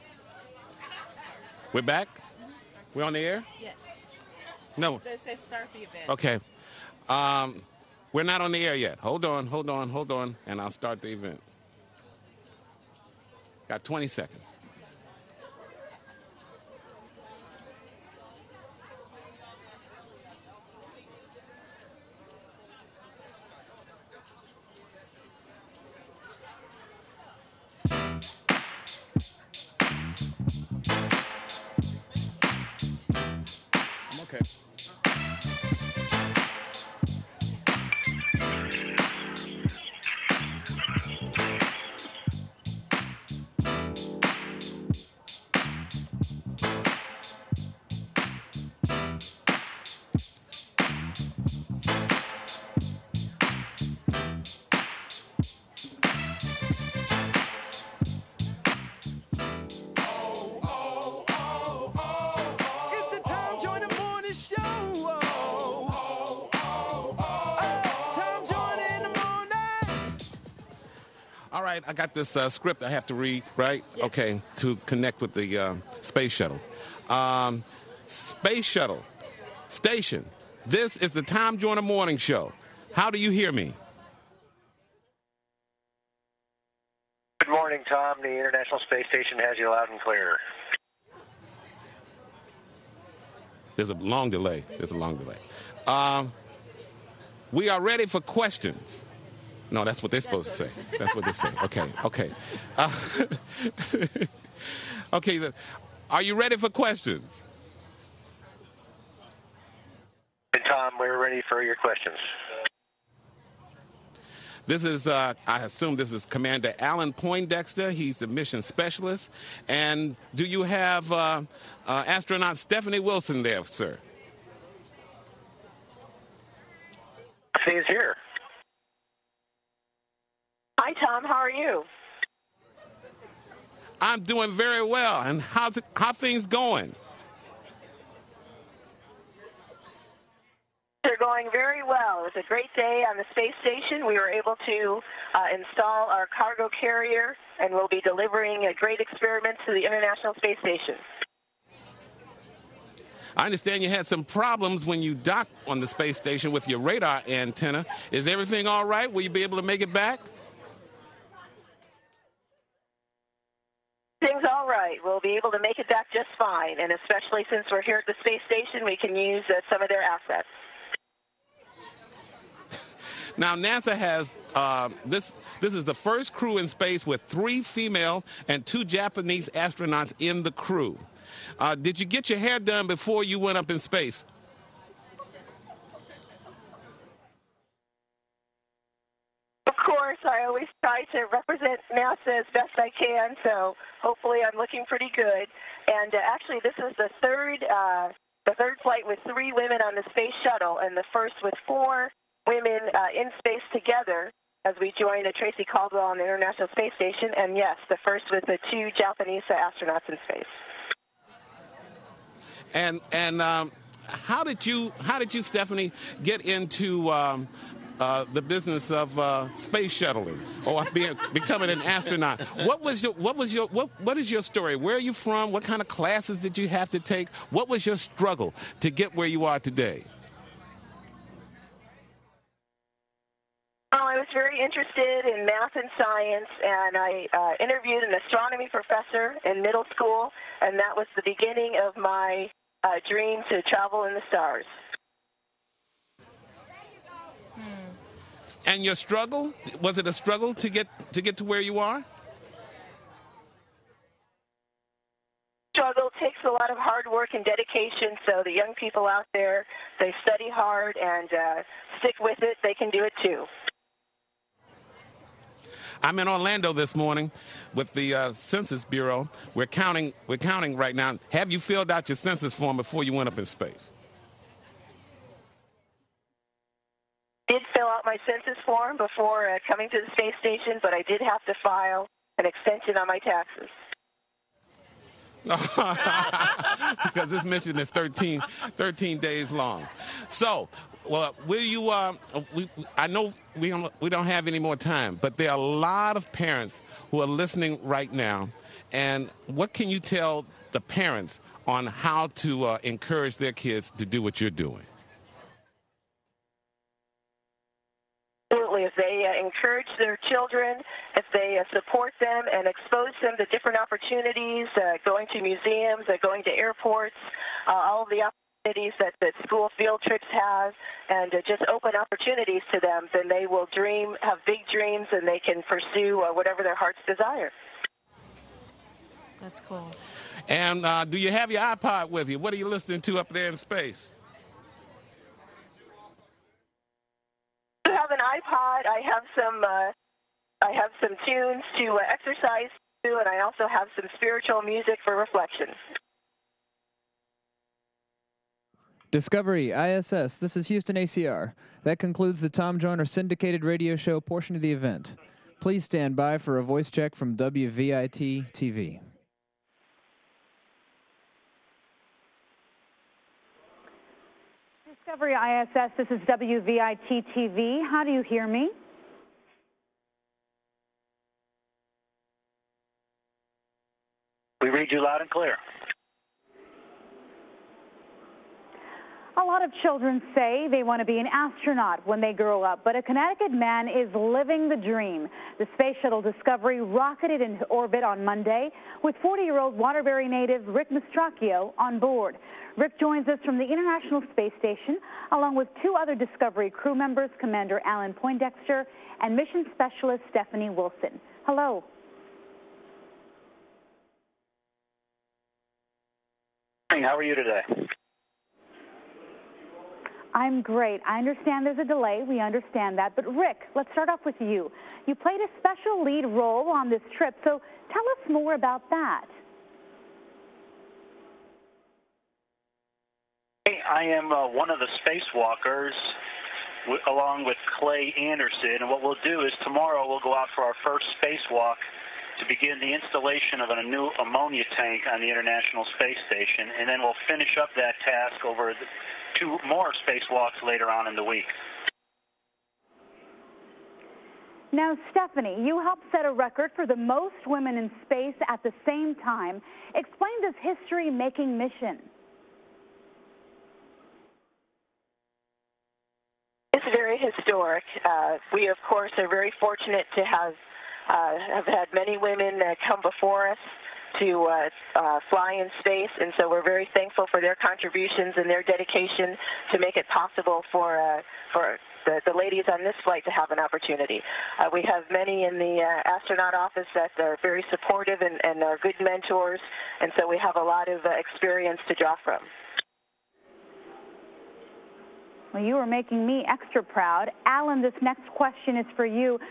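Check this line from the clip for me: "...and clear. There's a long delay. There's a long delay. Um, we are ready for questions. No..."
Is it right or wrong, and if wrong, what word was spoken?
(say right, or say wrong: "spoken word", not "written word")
right.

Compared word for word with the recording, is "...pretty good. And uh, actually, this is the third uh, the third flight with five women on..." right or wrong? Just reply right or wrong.
wrong.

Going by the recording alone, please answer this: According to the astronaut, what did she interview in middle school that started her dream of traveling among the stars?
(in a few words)
An astronomy professor.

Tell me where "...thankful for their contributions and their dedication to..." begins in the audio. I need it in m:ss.
7:46.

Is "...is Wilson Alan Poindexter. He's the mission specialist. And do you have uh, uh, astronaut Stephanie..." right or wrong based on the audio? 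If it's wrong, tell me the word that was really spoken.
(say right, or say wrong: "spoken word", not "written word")
wrong: "Commander", not "Wilson".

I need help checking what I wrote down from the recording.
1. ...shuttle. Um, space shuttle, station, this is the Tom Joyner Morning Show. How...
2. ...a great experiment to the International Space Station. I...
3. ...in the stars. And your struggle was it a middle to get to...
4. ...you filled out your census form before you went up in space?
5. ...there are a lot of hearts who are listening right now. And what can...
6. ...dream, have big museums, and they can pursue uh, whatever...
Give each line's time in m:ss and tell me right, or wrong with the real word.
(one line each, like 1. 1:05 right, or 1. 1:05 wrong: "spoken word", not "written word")
1. 1:16 right
2. 2:28 right
3. 4:04 wrong: "struggle", not "middle"
4. 4:31 right
5. 4:55 wrong: "parents", not "hearts"
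6. 5:23 wrong: "dreams", not "museums".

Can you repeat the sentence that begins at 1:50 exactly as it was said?
Tom, we're ready for your questions.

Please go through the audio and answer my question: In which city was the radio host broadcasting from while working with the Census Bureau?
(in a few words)
Orlando.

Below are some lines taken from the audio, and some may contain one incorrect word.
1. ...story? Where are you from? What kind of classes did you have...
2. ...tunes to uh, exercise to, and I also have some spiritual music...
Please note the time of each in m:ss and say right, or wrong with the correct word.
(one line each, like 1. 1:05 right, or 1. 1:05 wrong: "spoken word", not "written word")
1. 3:44 right
2. 5:41 right.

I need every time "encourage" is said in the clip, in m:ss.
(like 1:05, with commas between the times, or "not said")
5:02, 5:09.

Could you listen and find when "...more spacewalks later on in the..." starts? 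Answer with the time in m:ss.
7:19.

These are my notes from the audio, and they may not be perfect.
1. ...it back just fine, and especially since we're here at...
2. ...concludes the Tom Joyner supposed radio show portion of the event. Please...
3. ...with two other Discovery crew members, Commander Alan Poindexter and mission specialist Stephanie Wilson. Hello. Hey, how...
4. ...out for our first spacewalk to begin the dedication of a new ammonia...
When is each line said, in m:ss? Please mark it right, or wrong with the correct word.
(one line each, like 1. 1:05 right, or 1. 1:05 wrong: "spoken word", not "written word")
1. 2:45 right
2. 5:51 wrong: "syndicated", not "supposed"
3. 6:35 right
4. 7:10 wrong: "installation", not "dedication".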